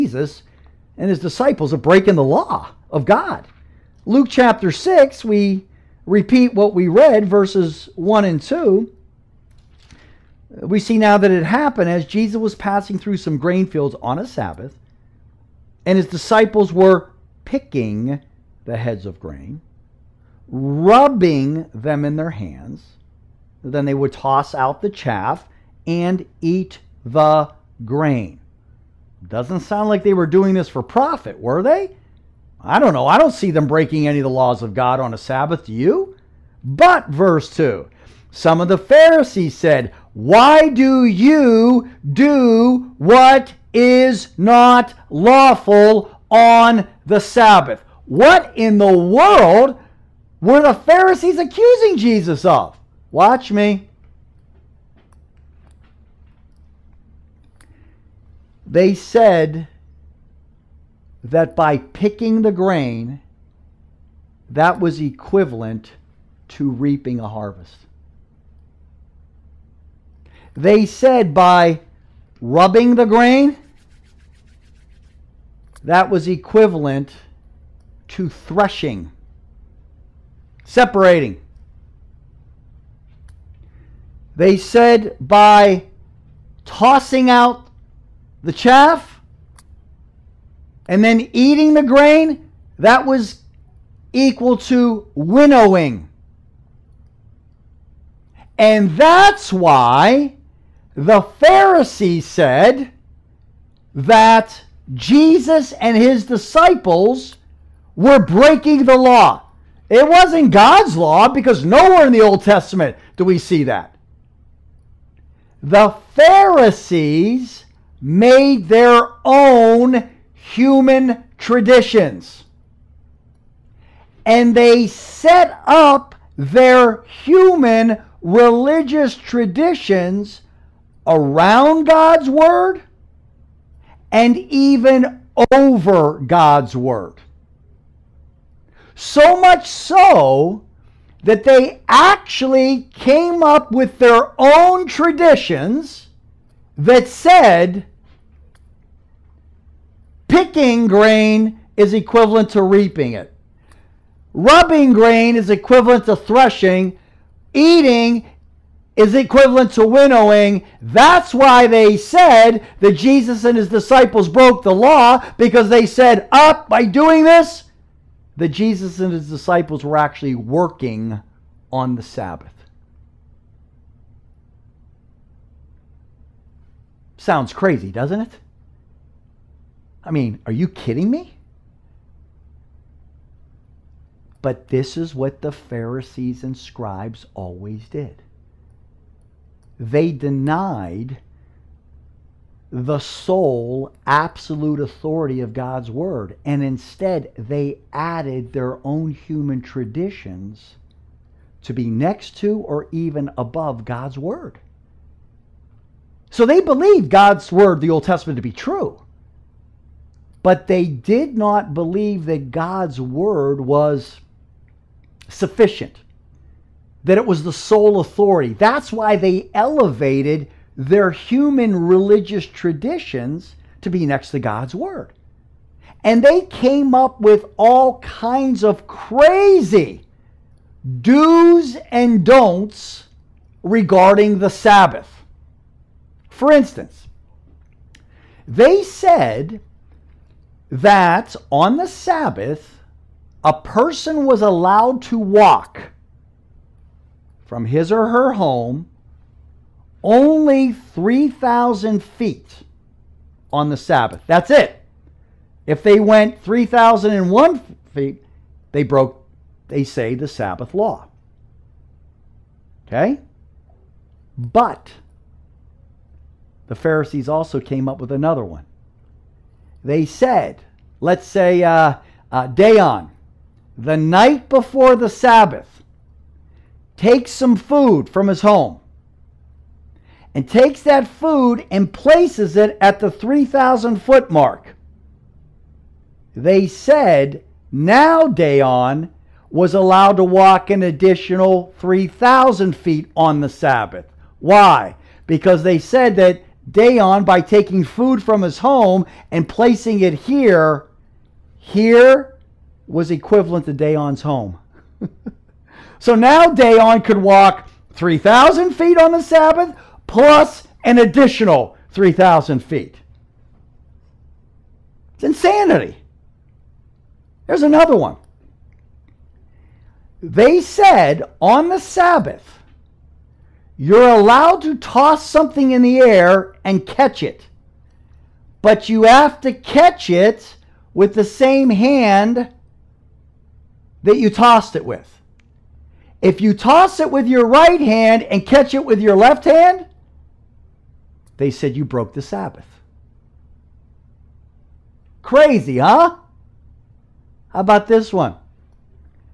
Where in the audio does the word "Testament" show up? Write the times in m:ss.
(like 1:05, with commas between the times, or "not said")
1:52, 3:28.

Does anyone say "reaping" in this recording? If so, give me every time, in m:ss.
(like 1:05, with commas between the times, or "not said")
1:06, 2:32.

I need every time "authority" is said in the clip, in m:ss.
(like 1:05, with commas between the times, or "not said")
3:14, 3:38.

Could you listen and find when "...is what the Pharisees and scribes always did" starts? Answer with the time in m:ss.
3:04.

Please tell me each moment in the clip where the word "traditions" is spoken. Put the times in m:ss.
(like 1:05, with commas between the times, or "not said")
2:01, 2:09, 2:24, 3:19, 3:42.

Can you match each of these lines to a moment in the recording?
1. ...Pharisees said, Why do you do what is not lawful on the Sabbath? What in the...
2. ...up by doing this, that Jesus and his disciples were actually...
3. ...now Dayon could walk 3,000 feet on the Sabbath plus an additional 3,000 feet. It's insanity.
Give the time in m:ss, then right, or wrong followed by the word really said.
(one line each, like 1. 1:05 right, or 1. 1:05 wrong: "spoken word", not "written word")
1. 0:38 right
2. 2:46 right
3. 5:06 right.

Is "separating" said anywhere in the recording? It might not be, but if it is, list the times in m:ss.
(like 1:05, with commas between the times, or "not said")
1:20.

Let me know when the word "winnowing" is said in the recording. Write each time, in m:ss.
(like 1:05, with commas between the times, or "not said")
1:35, 2:39.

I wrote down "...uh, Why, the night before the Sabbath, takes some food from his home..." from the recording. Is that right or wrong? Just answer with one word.
wrong.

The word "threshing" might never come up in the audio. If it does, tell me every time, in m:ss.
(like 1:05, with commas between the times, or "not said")
1:18, 2:36.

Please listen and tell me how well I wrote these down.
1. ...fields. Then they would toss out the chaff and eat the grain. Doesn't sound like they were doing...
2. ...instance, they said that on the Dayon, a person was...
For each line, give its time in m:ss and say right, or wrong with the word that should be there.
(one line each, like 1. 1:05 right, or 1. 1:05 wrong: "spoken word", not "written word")
1. 0:22 wrong: "hands", not "fields"
2. 3:56 wrong: "Sabbath", not "Dayon".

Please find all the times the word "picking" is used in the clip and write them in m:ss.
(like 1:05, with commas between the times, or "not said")
0:17, 1:01, 2:30.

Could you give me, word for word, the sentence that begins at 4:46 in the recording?
They said, now Dayon was allowed to walk an additional 3,000 feet on the Sabbath.